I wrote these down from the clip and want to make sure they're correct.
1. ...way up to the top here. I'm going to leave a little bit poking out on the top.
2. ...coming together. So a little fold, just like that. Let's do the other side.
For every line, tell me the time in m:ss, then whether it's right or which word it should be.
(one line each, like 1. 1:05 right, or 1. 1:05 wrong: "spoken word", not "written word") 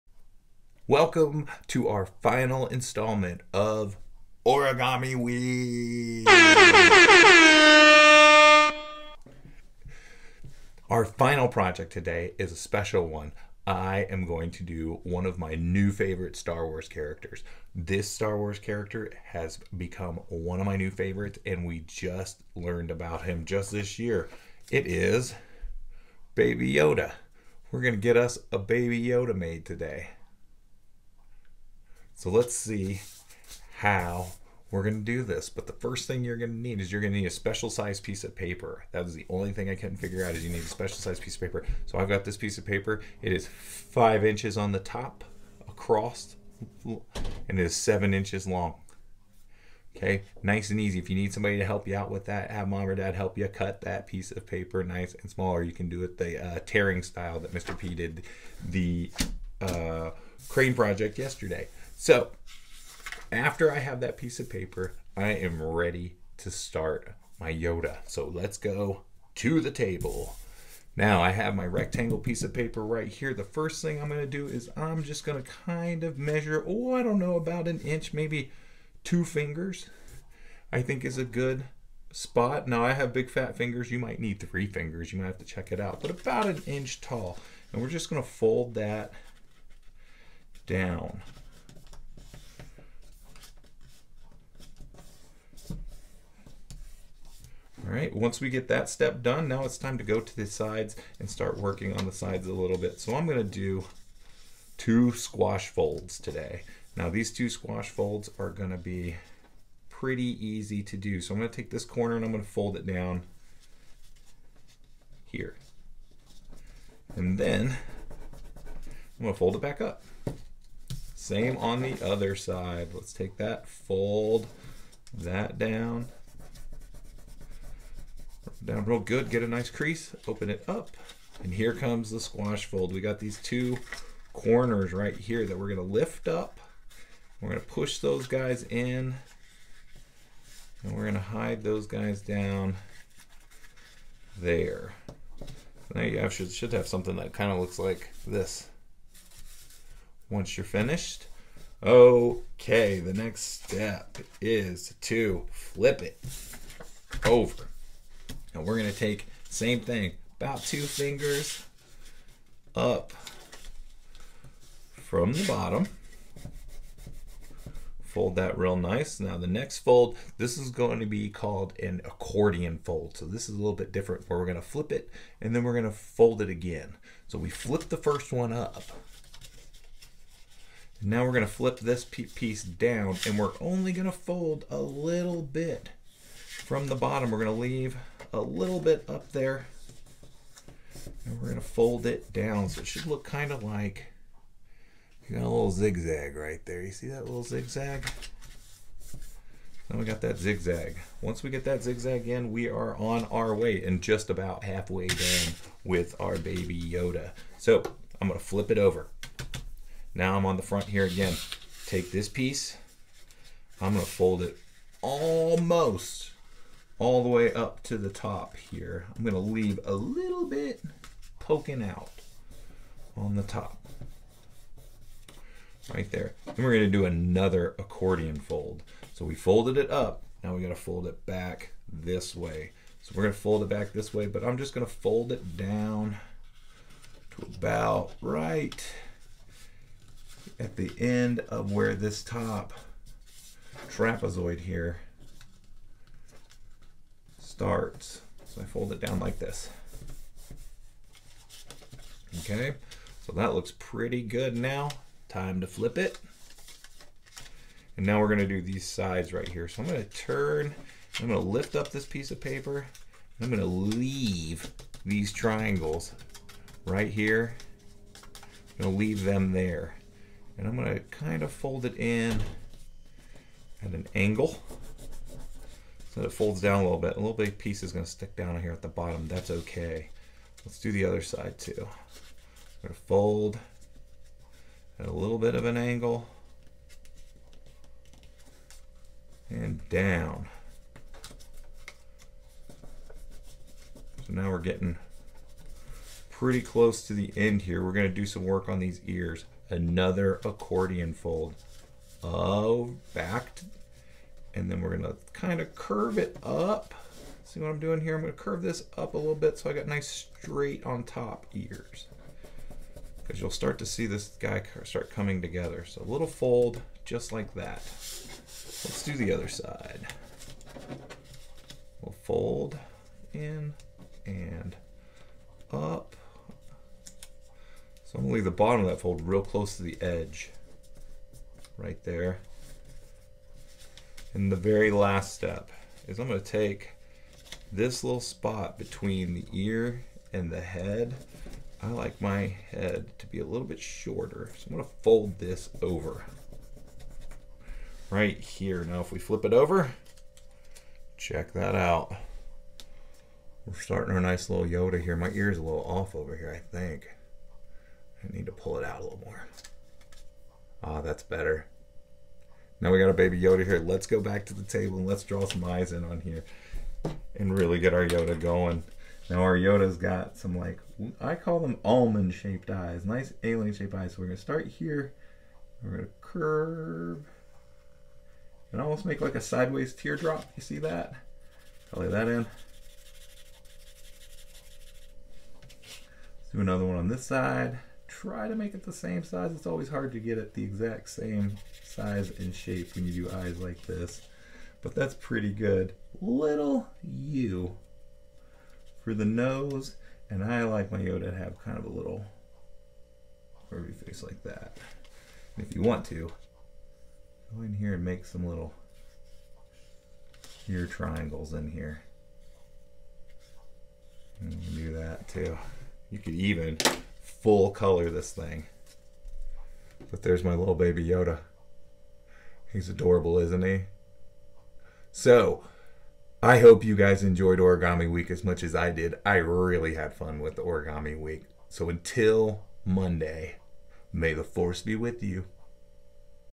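1. 3:37 right
2. 5:15 right.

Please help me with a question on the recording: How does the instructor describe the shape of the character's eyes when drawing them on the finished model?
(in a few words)
almond shaped.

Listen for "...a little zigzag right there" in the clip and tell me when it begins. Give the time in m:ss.
3:15.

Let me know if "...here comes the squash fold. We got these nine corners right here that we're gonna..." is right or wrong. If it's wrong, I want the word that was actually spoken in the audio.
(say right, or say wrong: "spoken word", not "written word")
wrong: "two", not "nine".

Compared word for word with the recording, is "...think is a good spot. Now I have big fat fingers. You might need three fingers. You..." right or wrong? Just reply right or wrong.
right.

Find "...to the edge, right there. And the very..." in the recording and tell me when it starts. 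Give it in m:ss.
5:29.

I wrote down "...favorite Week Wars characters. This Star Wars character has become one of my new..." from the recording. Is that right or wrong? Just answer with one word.
wrong.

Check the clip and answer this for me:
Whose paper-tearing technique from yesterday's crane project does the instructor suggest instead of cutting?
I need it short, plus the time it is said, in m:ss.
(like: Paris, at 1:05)
Mr. P, at 0:57.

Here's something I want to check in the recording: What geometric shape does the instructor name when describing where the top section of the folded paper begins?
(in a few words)
trapezoid.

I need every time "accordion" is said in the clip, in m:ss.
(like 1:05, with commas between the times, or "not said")
2:52, 3:47, 5:00.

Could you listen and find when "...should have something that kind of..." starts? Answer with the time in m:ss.
2:26.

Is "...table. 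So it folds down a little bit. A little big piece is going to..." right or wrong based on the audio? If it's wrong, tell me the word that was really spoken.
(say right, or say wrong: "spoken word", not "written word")
wrong: "angle", not "table".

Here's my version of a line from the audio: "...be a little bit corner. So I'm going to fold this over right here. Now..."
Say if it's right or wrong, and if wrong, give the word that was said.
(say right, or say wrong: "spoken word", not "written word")
wrong: "shorter", not "corner".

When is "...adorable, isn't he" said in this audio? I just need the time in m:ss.
7:02.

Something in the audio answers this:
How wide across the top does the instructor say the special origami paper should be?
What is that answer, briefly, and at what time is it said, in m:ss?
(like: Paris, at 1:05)
5 inches, at 0:43.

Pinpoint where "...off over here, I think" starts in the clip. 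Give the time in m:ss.
5:55.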